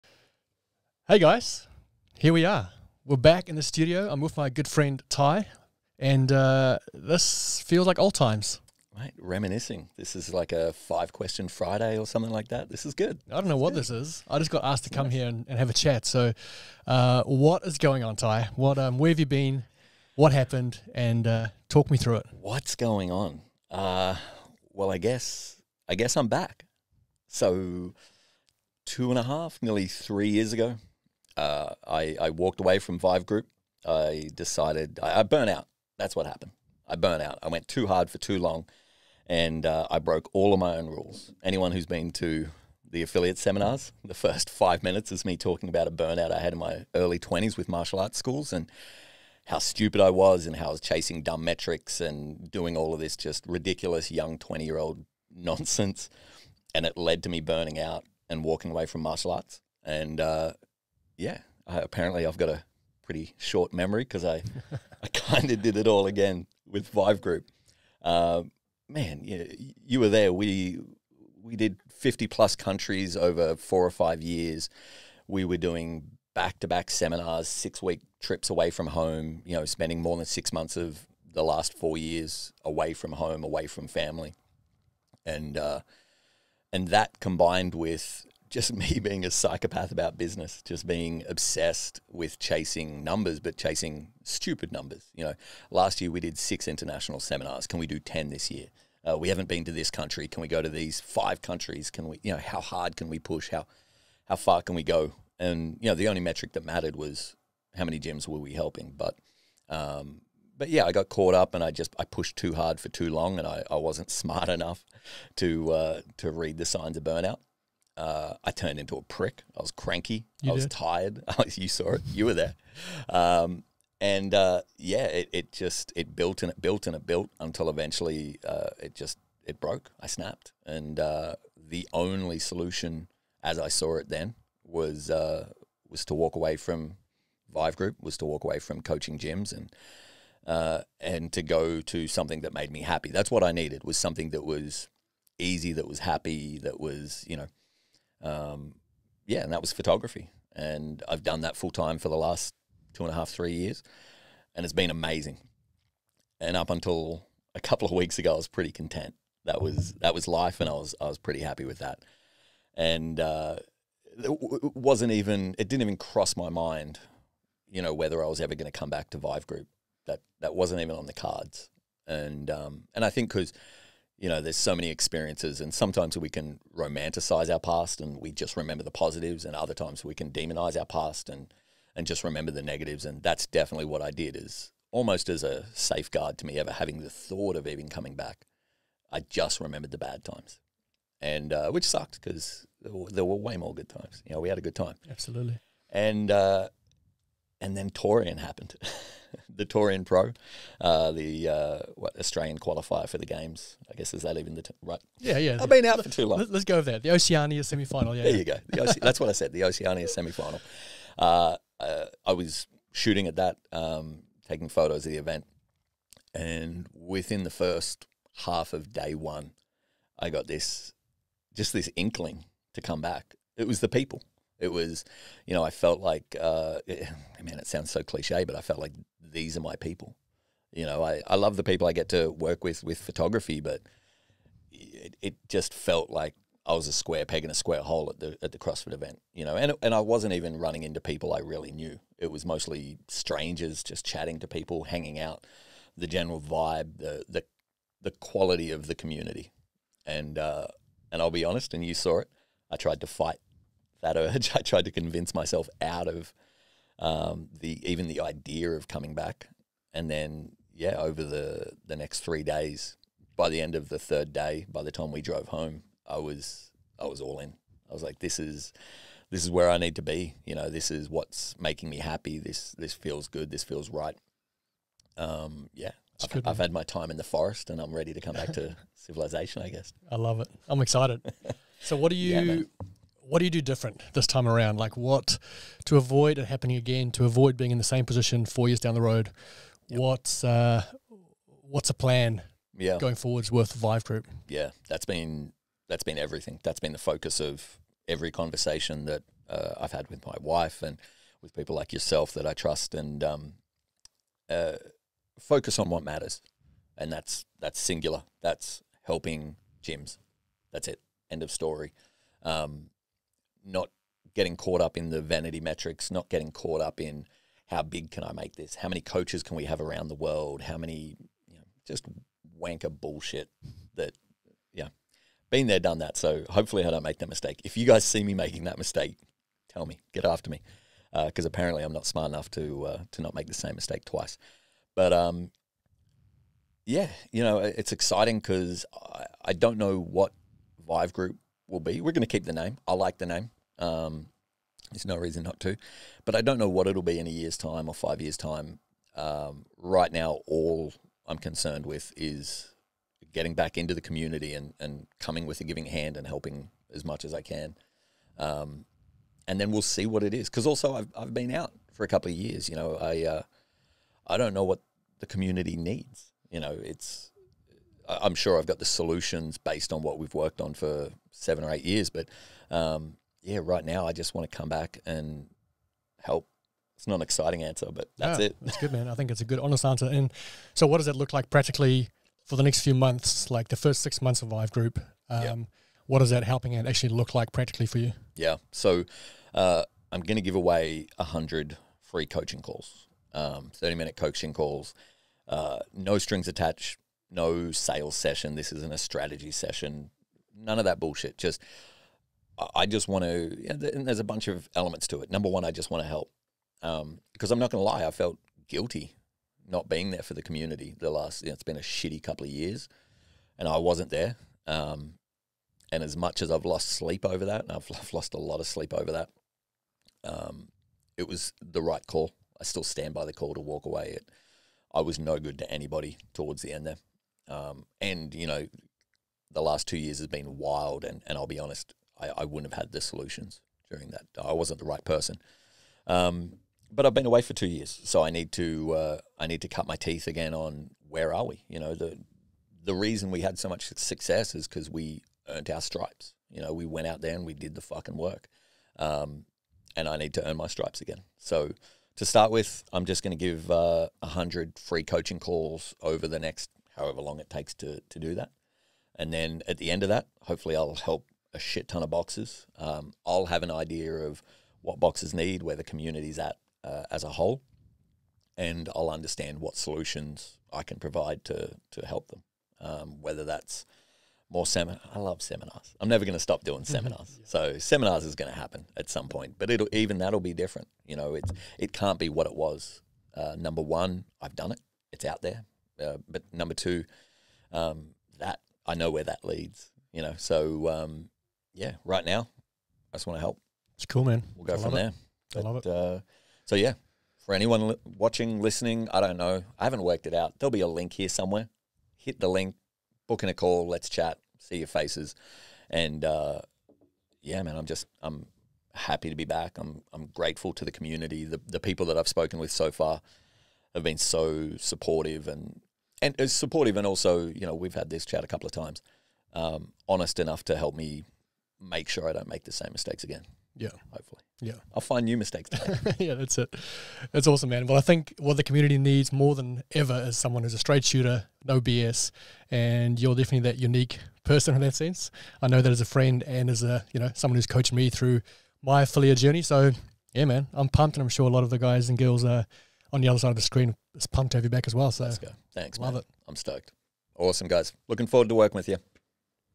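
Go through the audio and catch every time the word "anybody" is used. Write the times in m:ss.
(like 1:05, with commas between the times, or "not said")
7:05.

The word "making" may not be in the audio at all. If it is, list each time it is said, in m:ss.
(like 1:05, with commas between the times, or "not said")
4:31, 5:28.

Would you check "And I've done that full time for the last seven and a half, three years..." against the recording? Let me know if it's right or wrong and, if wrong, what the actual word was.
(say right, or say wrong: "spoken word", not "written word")
wrong: "two", not "seven".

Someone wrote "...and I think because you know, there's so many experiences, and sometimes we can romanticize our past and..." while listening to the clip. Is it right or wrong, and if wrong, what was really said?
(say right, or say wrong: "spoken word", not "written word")
right.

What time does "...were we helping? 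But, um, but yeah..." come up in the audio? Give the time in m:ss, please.
1:48.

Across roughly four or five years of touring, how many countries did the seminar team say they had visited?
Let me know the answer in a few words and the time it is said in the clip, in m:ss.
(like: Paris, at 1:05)
50, at 1:11.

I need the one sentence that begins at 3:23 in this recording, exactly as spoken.
I guess is that even the t- right?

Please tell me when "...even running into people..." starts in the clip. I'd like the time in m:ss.
4:00.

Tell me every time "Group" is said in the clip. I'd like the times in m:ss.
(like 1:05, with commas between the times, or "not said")
0:33, 1:07, 2:17, 2:49, 4:54, 5:41, 6:24.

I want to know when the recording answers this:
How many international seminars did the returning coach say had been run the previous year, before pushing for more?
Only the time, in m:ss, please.
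1:36.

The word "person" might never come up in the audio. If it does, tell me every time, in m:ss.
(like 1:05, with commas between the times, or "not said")
7:15, 8:54.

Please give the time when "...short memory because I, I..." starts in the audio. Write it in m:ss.
1:03.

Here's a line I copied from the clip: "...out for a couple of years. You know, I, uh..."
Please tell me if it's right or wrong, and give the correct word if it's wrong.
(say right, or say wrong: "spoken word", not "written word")
right.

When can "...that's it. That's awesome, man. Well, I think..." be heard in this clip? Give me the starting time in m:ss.
8:46.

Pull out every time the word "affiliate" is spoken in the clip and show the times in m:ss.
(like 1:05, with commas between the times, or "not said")
0:43, 8:59.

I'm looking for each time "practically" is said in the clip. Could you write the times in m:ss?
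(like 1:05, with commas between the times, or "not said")
6:21, 6:27.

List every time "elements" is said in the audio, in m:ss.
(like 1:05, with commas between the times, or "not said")
6:44.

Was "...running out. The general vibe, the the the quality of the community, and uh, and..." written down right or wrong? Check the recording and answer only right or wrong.
wrong.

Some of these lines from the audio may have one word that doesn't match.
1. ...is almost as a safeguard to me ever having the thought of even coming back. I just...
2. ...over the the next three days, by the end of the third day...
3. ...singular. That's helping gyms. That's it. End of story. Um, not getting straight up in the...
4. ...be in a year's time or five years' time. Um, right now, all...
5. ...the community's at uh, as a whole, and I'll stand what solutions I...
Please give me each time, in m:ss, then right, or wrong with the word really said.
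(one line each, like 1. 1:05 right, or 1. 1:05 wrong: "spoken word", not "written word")
1. 3:04 right
2. 4:20 right
3. 5:07 wrong: "caught", not "straight"
4. 5:47 right
5. 7:45 wrong: "understand", not "stand".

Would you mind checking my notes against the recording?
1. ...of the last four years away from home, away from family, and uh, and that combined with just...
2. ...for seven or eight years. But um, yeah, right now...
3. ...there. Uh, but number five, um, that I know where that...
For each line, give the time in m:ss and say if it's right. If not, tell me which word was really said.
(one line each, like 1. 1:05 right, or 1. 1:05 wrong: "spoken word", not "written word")
1. 1:20 right
2. 6:10 right
3. 8:05 wrong: "two", not "five".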